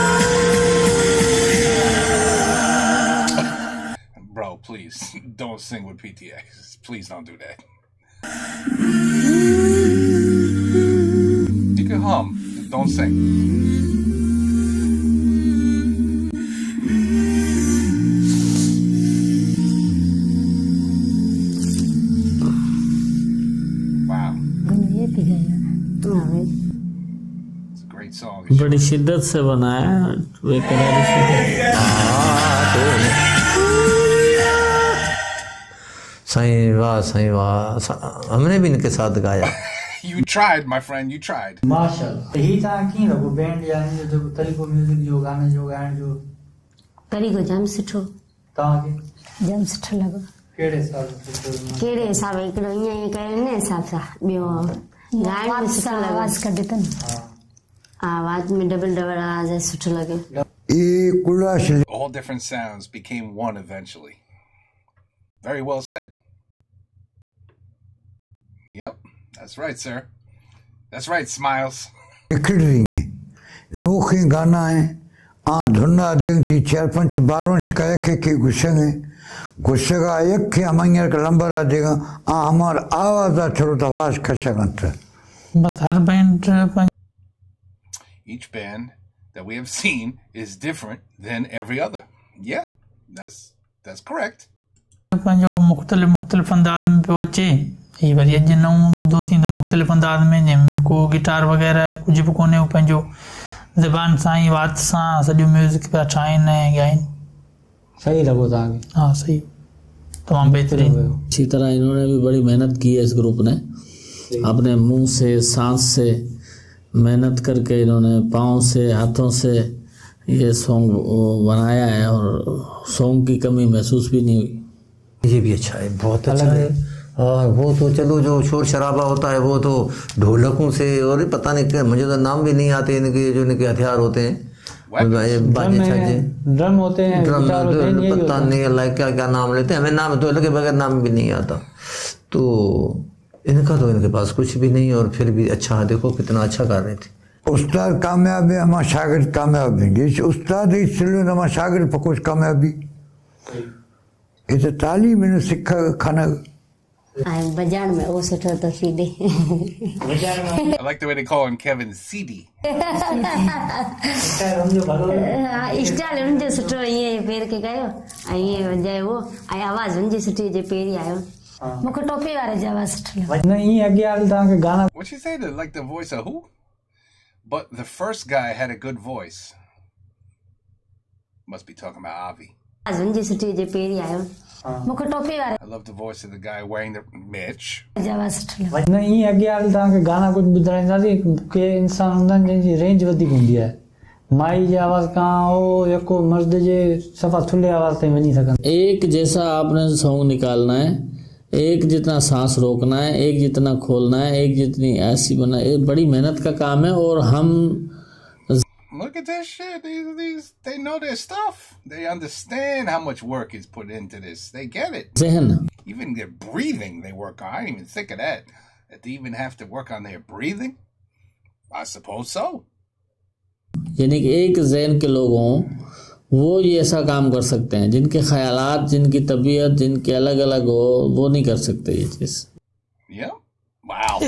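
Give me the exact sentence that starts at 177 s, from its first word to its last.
But the first guy had a good voice.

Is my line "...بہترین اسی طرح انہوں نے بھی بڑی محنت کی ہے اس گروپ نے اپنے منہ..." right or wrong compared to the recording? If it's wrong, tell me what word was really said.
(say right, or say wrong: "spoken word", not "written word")
right.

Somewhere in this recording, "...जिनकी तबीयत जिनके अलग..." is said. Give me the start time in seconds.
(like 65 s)
228 s.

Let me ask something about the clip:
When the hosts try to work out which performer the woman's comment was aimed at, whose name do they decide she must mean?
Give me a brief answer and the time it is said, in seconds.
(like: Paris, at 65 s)
Avi, at 182 s.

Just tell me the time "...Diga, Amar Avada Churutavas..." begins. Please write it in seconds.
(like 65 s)
81 s.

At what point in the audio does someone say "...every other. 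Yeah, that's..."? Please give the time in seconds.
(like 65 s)
91 s.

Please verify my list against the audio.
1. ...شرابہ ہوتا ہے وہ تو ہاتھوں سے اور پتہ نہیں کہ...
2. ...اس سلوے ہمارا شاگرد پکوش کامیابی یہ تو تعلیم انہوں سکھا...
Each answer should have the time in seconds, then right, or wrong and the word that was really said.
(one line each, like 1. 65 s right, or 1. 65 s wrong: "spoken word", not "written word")
1. 128 s wrong: "ڈھولکوں", not "ہاتھوں"
2. 150 s right.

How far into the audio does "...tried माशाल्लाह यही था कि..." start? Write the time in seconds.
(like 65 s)
41 s.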